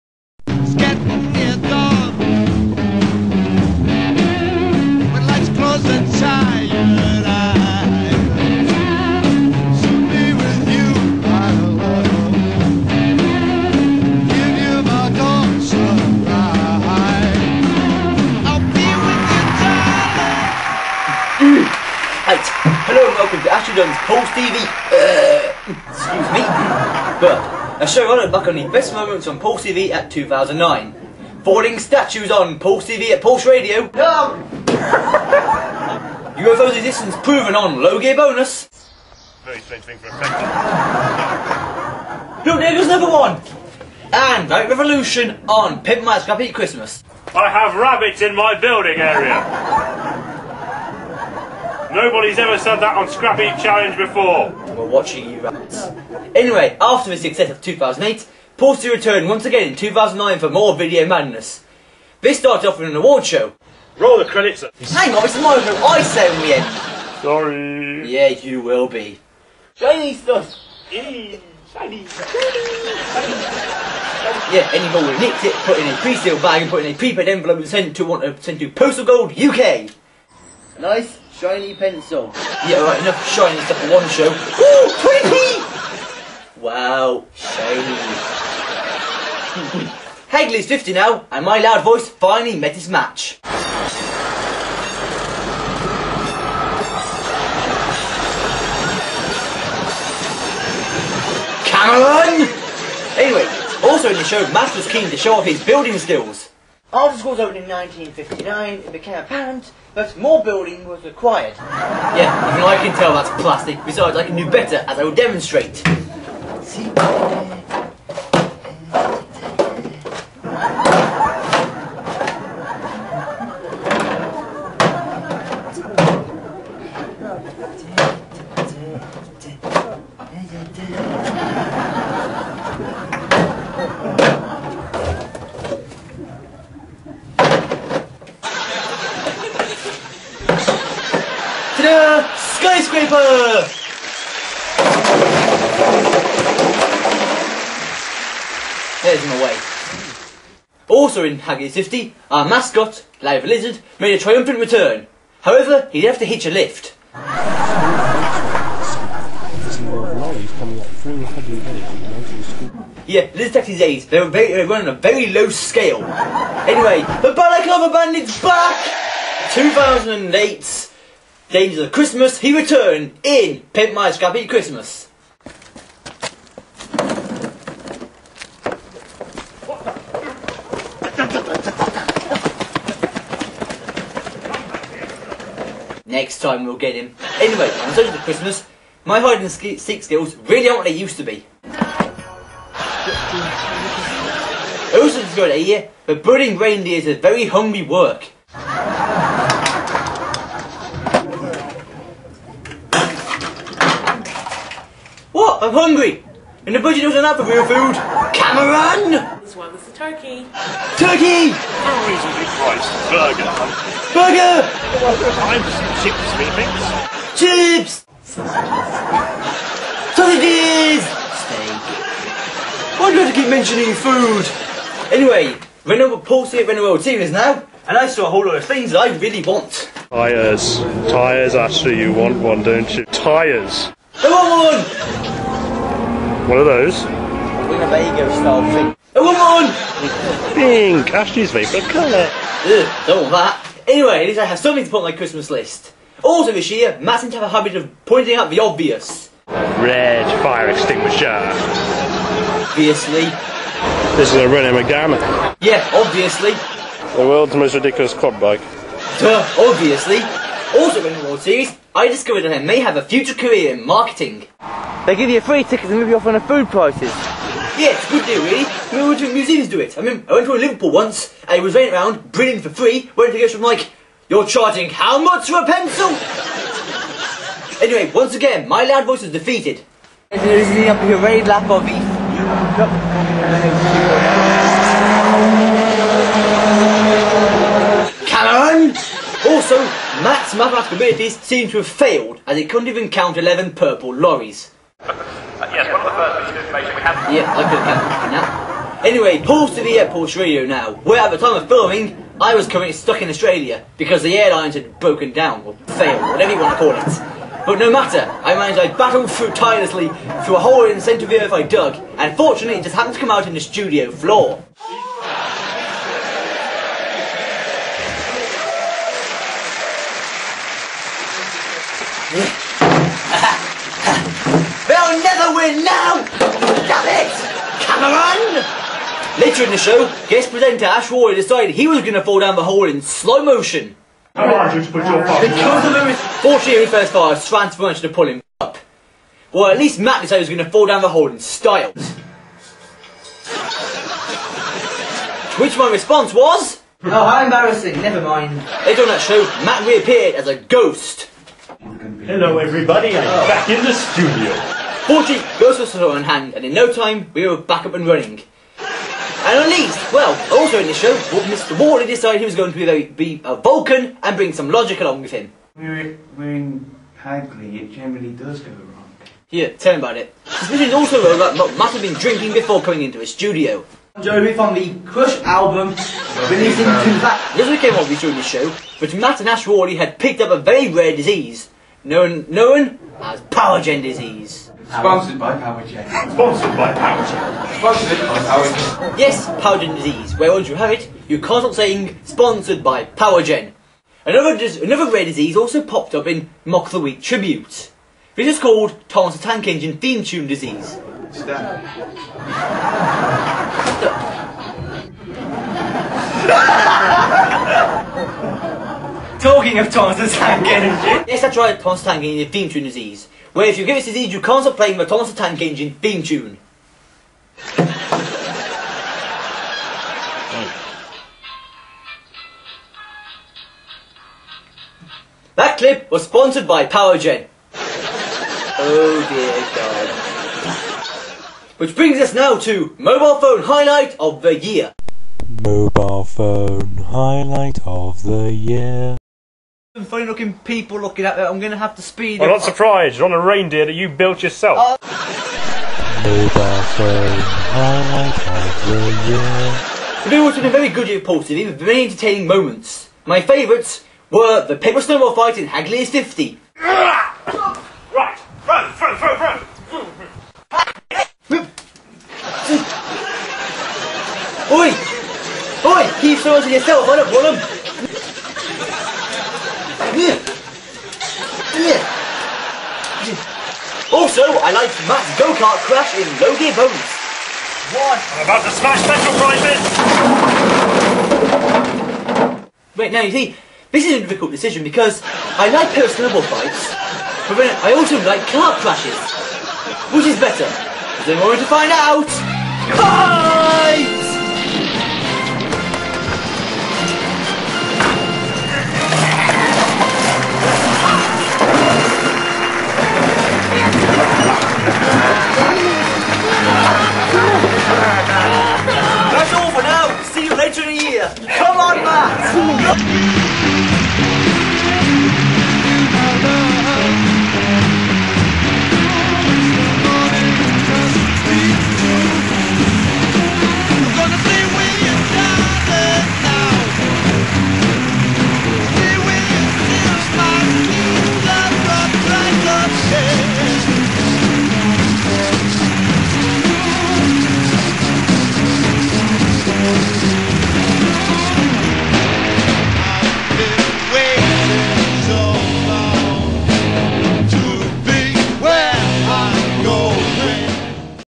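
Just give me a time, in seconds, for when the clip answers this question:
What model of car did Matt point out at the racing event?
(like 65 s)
254 s.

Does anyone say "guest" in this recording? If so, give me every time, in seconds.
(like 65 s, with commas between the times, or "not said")
330 s.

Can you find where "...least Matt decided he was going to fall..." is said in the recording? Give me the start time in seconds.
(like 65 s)
339 s.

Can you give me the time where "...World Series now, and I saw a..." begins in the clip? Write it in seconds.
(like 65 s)
226 s.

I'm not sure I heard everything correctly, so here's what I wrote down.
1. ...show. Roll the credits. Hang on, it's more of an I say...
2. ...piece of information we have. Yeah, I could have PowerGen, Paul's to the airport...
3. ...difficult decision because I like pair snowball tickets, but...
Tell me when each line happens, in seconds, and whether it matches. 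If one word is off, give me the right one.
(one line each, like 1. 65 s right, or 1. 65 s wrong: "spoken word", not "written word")
1. 63 s right
2. 296 s wrong: "Anyway", not "PowerGen"
3. 484 s wrong: "fights", not "tickets".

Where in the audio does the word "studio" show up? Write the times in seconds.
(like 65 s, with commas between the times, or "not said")
313 s, 353 s, 373 s.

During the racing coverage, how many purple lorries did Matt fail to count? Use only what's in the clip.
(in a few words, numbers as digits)
11.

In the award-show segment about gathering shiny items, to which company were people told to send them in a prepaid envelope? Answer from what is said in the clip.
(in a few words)
Postal Gold UK.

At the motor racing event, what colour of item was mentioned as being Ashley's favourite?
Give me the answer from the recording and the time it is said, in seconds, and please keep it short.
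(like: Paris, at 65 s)
Pink, at 240 s.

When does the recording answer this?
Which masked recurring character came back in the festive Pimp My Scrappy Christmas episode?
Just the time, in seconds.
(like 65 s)
167 s.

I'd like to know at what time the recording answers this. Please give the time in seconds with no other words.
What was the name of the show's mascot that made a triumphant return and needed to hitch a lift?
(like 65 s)
153 s.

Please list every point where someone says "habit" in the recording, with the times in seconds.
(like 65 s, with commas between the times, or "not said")
247 s.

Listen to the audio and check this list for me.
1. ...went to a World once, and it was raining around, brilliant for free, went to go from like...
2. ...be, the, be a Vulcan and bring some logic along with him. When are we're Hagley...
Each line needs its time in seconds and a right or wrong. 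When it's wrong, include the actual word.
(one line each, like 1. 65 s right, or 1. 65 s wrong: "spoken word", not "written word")
1. 270 s wrong: "Liverpool", not "World"
2. 362 s right.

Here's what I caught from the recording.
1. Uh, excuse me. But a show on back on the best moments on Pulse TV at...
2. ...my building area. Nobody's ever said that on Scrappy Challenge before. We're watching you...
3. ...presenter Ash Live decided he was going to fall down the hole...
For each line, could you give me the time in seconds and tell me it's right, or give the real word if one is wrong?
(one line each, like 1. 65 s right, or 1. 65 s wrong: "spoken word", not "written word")
1. 24 s right
2. 48 s right
3. 330 s wrong: "Roy", not "Live".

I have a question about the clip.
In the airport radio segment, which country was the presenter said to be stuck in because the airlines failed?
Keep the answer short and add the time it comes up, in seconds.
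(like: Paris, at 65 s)
Australia, at 303 s.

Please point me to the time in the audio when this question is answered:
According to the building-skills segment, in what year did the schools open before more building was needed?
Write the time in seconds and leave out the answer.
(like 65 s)
107 s.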